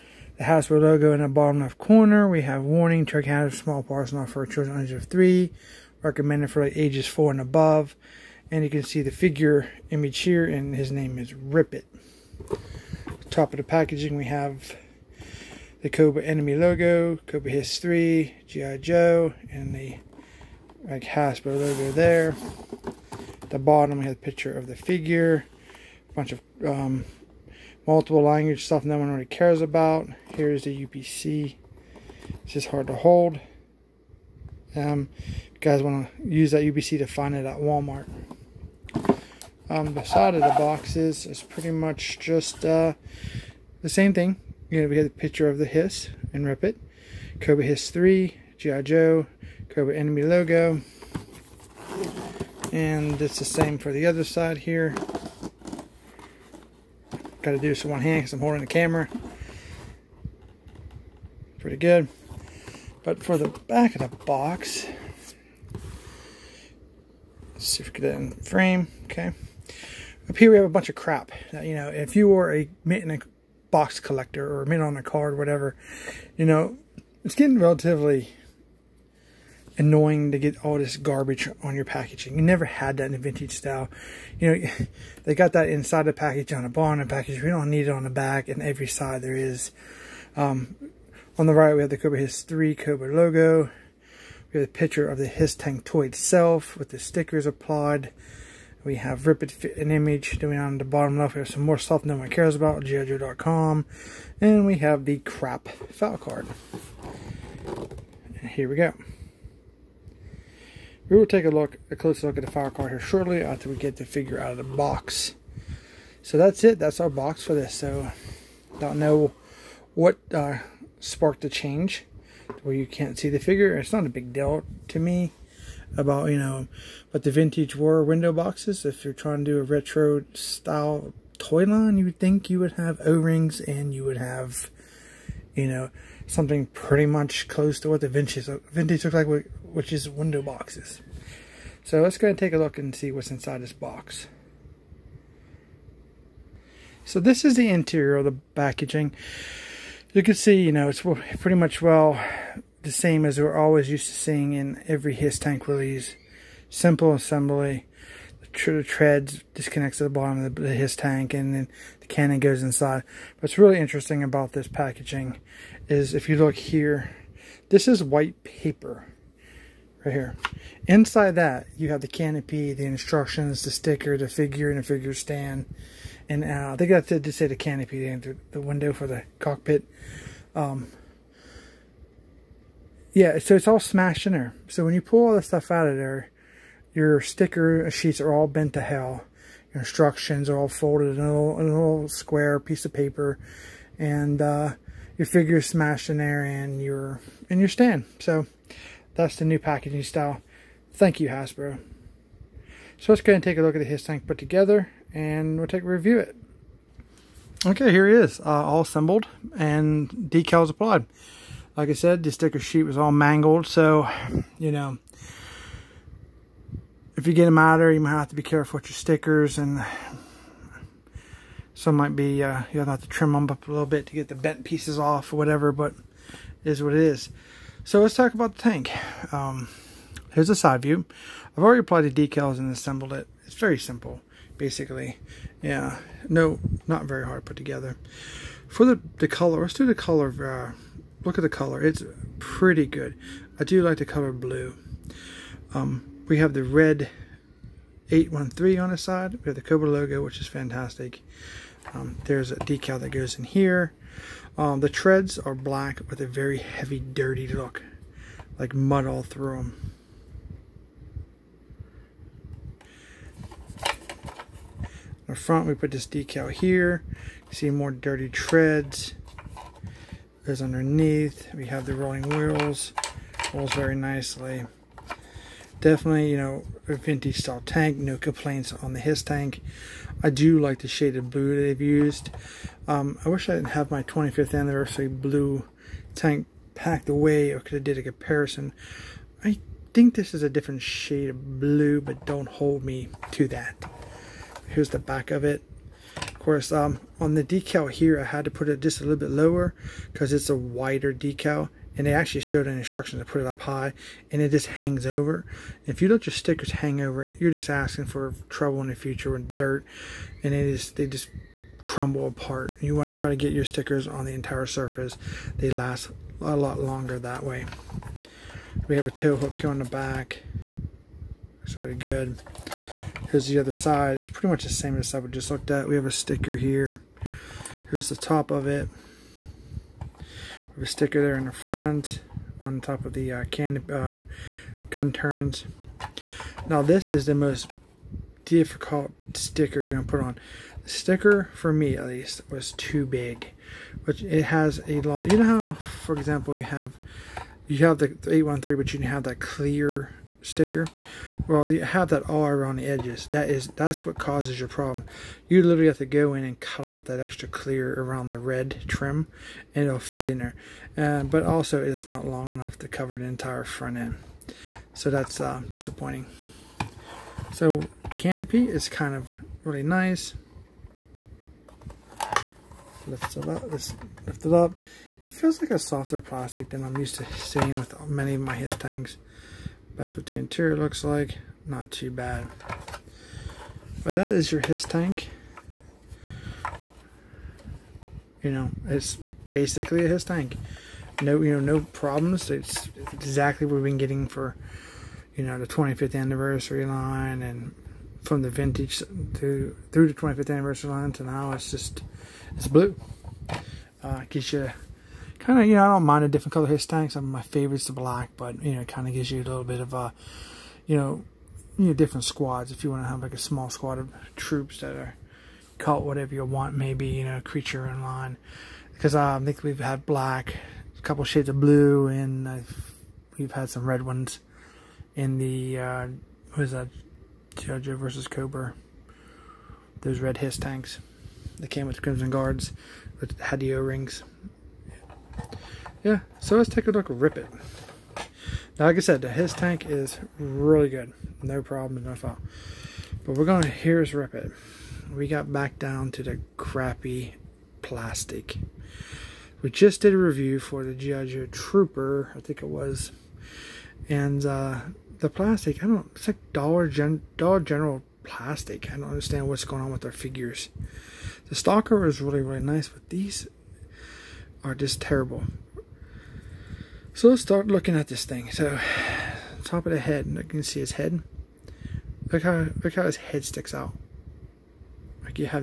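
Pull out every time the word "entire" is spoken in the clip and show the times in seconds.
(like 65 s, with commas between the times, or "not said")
314 s, 363 s.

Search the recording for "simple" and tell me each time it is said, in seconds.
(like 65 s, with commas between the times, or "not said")
156 s, 233 s.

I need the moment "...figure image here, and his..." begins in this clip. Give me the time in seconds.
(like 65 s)
9 s.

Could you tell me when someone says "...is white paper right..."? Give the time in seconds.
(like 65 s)
167 s.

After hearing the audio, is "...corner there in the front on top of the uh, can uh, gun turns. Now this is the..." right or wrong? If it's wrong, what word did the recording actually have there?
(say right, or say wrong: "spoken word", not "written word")
wrong: "sticker", not "corner".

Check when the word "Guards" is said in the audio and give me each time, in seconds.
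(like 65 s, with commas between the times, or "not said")
432 s.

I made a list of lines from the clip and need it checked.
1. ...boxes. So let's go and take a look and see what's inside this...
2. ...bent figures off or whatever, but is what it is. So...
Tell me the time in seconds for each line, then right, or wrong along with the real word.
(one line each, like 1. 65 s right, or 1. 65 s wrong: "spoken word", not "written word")
1. 140 s right
2. 224 s wrong: "pieces", not "figures".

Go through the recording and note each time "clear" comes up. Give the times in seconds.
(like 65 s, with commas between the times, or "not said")
349 s, 357 s.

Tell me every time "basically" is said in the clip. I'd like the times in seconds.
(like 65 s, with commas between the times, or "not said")
234 s, 389 s.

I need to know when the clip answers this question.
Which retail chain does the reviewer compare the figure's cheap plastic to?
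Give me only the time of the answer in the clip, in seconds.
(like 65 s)
457 s.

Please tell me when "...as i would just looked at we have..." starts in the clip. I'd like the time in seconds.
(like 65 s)
324 s.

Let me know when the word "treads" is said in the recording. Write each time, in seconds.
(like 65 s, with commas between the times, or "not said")
158 s, 254 s, 268 s.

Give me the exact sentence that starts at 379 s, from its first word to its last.
That's what the interior looks like.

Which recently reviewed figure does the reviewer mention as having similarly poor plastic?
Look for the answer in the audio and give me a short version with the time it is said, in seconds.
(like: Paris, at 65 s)
Judge Trooper, at 450 s.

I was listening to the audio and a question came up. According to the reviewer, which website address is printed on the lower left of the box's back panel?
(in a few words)
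GIJoe.com.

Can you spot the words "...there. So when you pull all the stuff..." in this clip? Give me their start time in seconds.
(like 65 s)
184 s.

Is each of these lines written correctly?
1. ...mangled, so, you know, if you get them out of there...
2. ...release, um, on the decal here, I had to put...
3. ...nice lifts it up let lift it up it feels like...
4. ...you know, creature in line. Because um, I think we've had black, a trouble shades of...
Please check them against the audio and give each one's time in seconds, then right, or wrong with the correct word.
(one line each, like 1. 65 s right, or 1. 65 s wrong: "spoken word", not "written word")
1. 213 s right
2. 296 s wrong: "course", not "release"
3. 369 s right
4. 417 s wrong: "couple", not "trouble".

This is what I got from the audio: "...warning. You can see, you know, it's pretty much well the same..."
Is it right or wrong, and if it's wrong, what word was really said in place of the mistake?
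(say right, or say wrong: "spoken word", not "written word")
wrong: "packaging", not "warning".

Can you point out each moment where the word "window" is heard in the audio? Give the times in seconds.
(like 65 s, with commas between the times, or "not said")
128 s, 140 s, 178 s.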